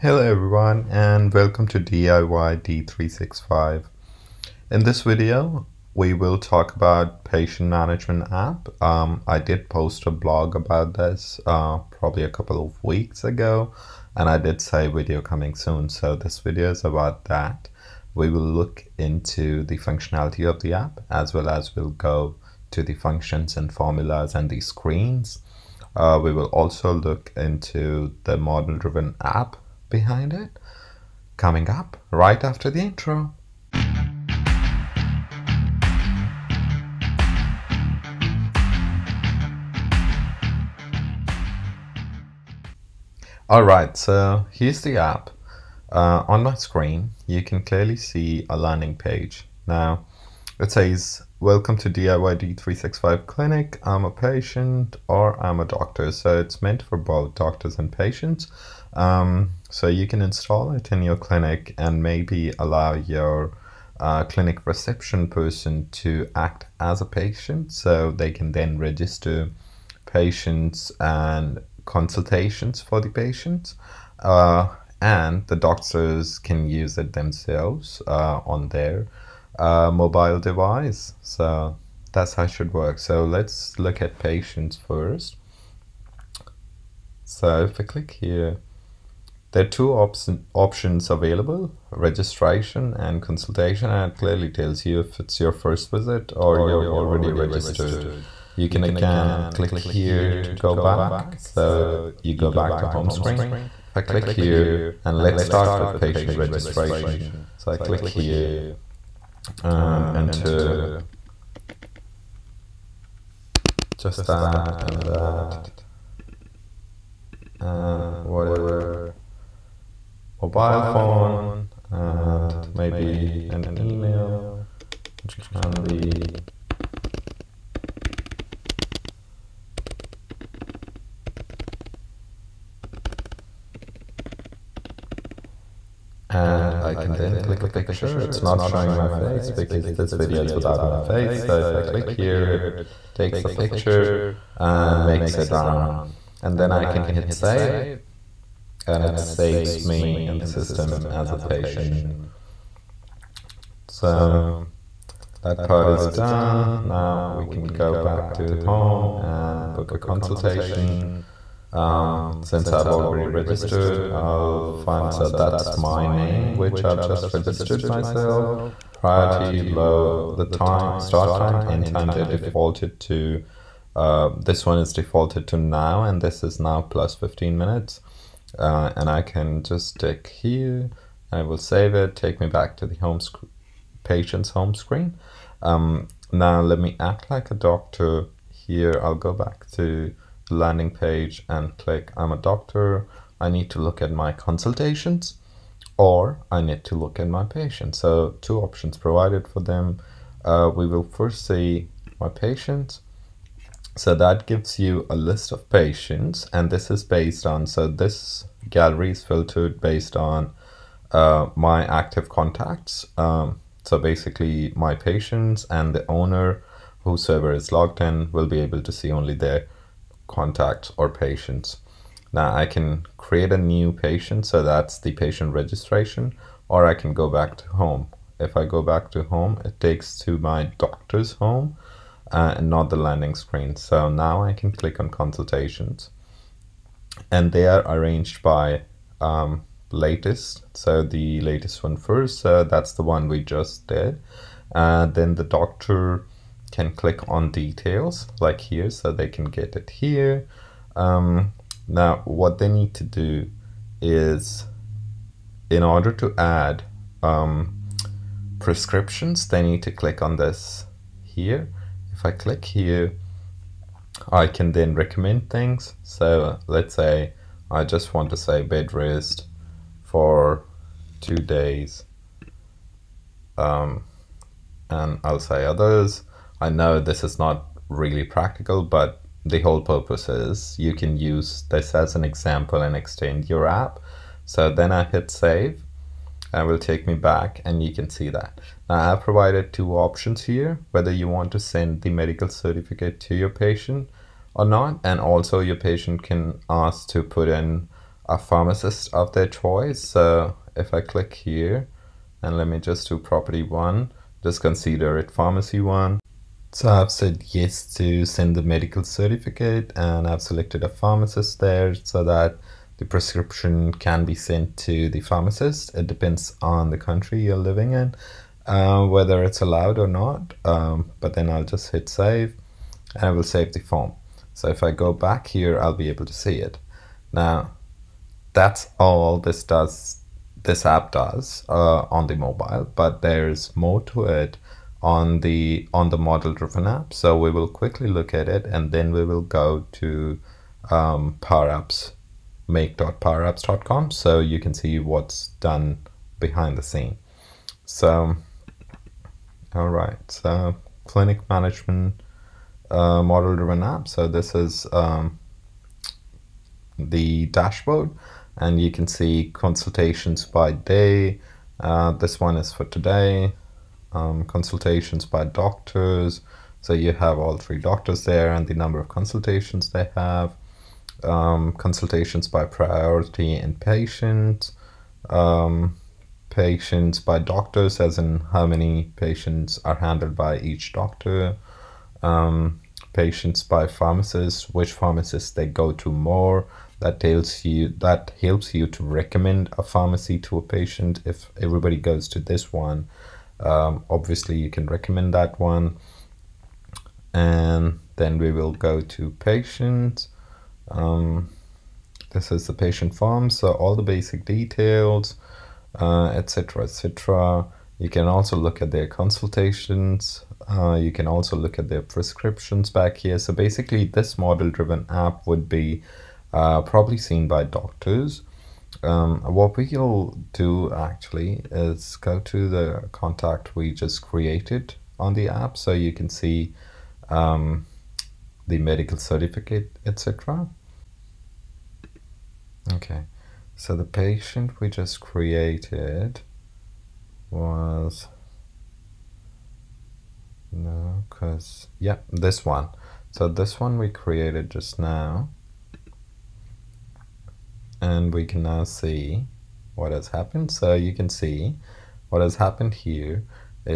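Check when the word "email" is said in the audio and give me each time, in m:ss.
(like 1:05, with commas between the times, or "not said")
2:03.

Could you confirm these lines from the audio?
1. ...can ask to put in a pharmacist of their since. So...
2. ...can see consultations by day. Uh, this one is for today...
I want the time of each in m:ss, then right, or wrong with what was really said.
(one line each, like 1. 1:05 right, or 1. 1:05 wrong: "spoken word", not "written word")
1. 4:56 wrong: "choice", not "since"
2. 5:58 right.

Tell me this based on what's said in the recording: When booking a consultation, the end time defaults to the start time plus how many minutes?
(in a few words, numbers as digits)
15.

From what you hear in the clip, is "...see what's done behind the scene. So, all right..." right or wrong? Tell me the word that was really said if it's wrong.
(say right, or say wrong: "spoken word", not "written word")
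right.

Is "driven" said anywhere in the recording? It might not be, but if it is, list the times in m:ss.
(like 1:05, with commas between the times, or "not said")
0:28, 5:36, 5:53, 6:54.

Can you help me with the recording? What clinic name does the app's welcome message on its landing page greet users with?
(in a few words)
DIY D365 Clinic.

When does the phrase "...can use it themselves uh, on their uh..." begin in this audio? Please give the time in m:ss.
1:16.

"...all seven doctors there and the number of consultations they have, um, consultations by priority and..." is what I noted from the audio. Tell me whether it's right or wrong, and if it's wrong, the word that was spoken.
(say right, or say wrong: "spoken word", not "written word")
wrong: "three", not "seven".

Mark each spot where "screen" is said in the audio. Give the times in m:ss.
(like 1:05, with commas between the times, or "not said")
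0:24, 0:46, 1:43, 3:04, 3:53.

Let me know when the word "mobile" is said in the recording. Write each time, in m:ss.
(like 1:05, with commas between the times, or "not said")
1:19, 2:00, 5:32.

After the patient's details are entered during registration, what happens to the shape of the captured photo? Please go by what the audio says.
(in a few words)
Makes it round.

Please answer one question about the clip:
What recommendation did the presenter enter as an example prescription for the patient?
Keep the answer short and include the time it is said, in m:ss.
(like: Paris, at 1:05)
Bed rest for two days, at 4:28.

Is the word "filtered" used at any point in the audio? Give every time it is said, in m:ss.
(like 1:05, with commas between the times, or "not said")
3:29.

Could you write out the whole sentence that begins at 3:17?
So two options provided for them.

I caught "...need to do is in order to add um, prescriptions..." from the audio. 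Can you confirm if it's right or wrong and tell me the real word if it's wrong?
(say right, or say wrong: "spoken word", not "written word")
right.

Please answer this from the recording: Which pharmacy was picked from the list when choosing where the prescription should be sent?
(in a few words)
Pharmacy one.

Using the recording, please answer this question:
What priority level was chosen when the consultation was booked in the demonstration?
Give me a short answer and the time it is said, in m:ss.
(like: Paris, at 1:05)
Low, at 2:48.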